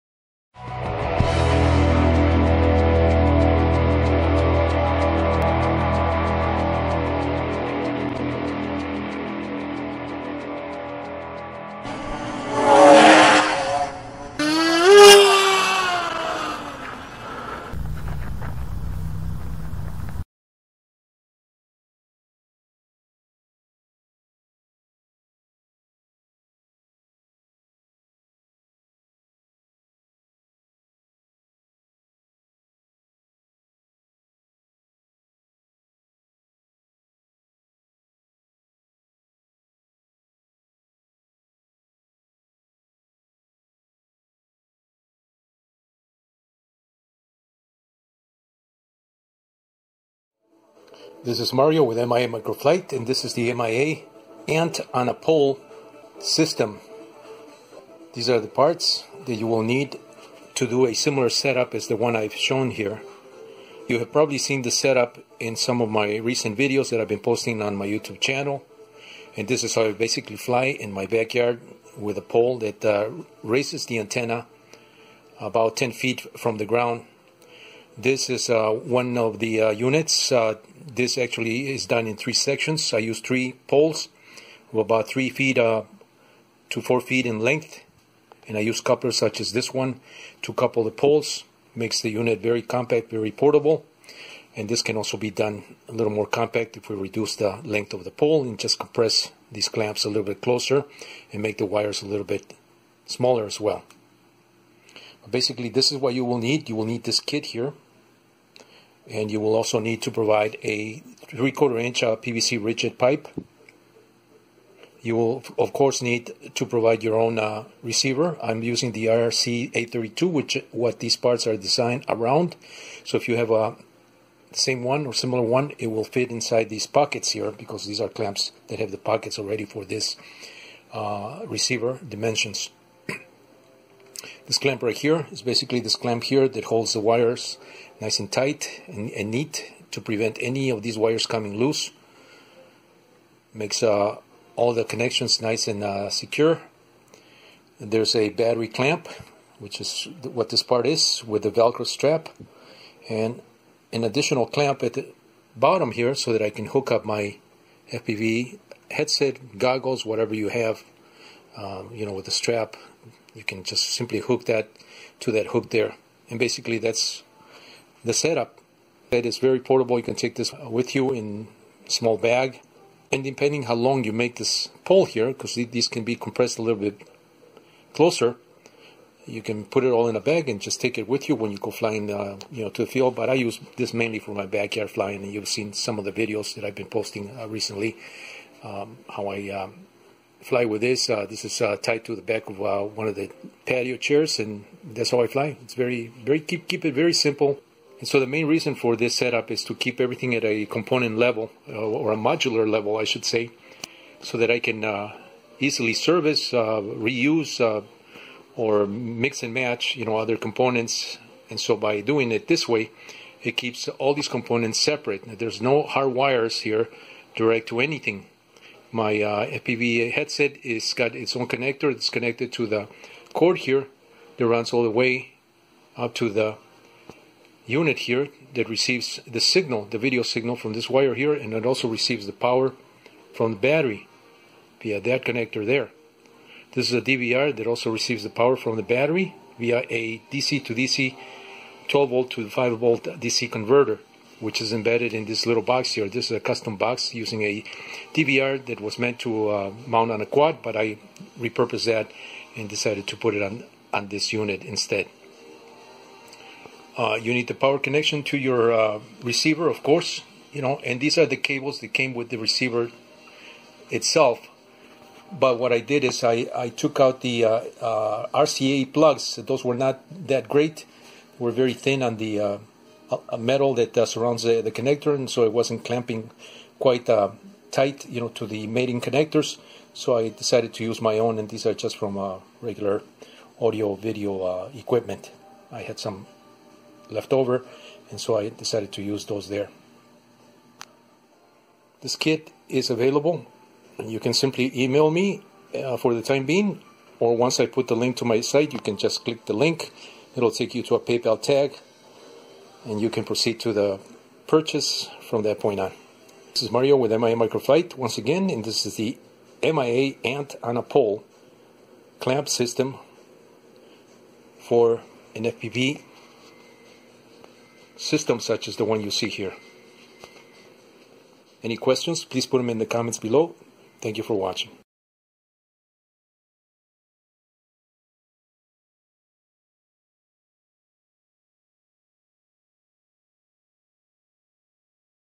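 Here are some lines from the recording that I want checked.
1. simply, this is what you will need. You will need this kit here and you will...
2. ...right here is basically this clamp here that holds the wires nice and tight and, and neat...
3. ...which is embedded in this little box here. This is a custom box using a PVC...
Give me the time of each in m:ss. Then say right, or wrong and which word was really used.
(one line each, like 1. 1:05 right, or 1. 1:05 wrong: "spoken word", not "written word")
1. 1:45 wrong: "basically", not "simply"
2. 2:14 right
3. 4:04 wrong: "DVR", not "PVC".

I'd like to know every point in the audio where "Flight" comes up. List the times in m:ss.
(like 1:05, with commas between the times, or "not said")
0:52, 5:07.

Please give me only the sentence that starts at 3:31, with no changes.
And so by doing it this way, it keeps all these components separate.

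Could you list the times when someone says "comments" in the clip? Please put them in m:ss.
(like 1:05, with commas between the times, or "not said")
5:22.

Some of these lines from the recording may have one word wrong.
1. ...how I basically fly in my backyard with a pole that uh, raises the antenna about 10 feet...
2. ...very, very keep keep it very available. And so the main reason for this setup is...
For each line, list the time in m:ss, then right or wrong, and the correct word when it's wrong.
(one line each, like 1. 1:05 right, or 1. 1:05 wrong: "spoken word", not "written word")
1. 1:09 right
2. 3:15 wrong: "simple", not "available".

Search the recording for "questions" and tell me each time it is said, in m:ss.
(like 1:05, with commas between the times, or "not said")
5:21.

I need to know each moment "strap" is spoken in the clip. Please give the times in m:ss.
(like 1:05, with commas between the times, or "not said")
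2:31, 2:42.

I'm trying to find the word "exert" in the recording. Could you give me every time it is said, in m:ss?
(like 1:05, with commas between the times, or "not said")
not said.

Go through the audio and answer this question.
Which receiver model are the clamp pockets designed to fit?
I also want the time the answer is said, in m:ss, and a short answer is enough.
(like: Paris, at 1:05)
IRC832, at 1:59.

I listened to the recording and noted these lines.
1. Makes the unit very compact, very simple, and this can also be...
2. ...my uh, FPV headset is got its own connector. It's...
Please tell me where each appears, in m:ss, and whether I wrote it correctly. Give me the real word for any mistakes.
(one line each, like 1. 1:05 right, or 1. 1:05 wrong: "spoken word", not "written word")
1. 1:31 wrong: "portable", not "simple"
2. 3:38 right.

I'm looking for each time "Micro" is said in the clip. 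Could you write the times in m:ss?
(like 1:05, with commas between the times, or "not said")
0:52, 5:07.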